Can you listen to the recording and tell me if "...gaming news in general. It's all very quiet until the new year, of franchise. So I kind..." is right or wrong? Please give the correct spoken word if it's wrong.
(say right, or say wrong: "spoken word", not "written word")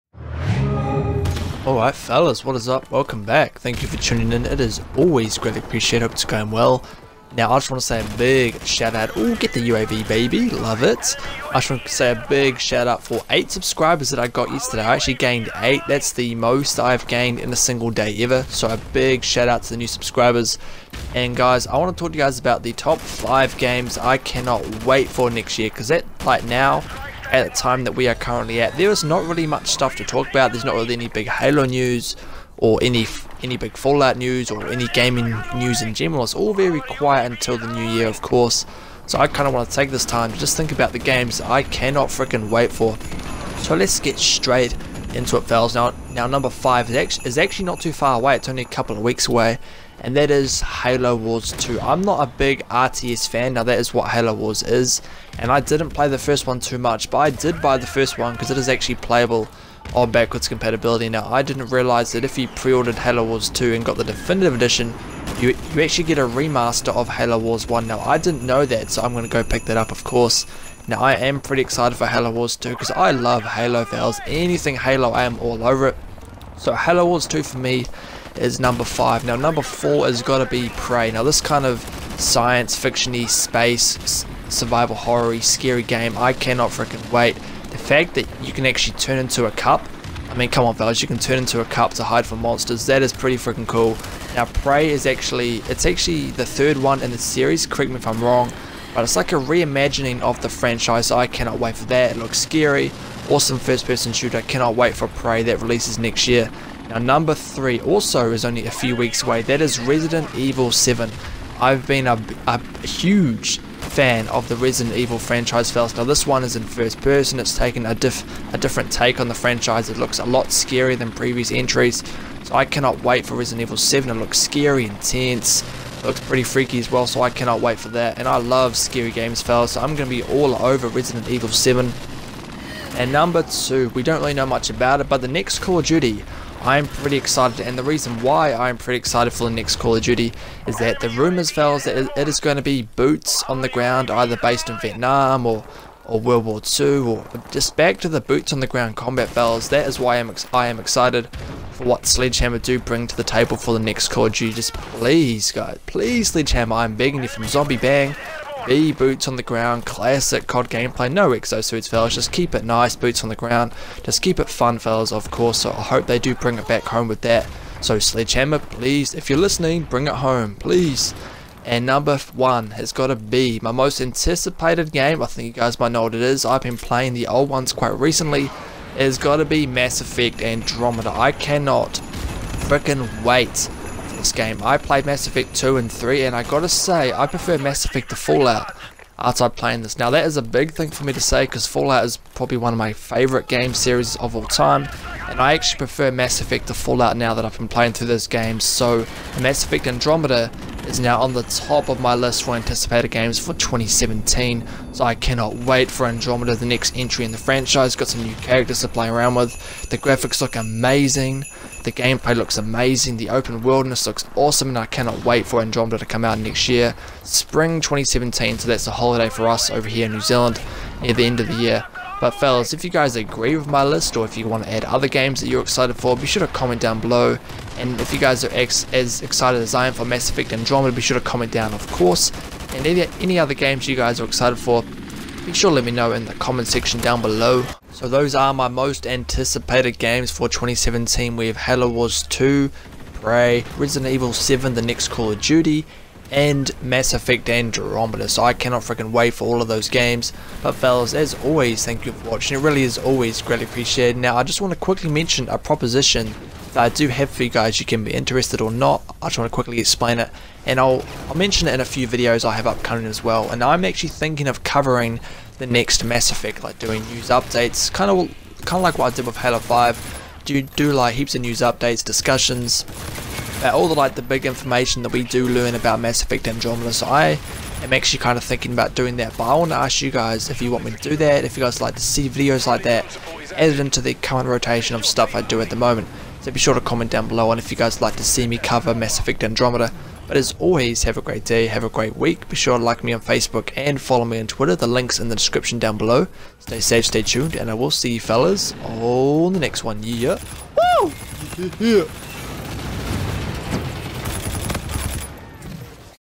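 wrong: "course", not "franchise".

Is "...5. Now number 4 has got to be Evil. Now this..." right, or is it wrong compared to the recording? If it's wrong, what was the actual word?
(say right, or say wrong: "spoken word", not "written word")
wrong: "Prey", not "Evil".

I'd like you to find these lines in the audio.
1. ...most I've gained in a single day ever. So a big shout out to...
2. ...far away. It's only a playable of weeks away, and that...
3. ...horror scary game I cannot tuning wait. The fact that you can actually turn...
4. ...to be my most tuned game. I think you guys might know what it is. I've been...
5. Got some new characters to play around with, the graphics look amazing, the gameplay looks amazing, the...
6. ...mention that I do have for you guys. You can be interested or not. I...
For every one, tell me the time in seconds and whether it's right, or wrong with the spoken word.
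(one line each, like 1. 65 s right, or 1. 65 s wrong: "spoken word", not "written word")
1. 16 s right
2. 47 s wrong: "couple", not "playable"
3. 84 s wrong: "freaking", not "tuning"
4. 173 s wrong: "anticipated", not "tuned"
5. 207 s right
6. 255 s wrong: "proposition", not "mention".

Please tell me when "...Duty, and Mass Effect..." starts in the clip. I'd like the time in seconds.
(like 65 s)
245 s.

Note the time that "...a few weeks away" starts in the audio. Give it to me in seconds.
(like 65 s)
108 s.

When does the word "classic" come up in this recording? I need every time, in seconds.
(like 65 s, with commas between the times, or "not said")
159 s.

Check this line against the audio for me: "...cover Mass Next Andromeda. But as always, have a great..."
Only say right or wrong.
wrong.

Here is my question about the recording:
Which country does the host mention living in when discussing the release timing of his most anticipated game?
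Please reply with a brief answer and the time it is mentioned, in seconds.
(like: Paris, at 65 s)
New Zealand, at 220 s.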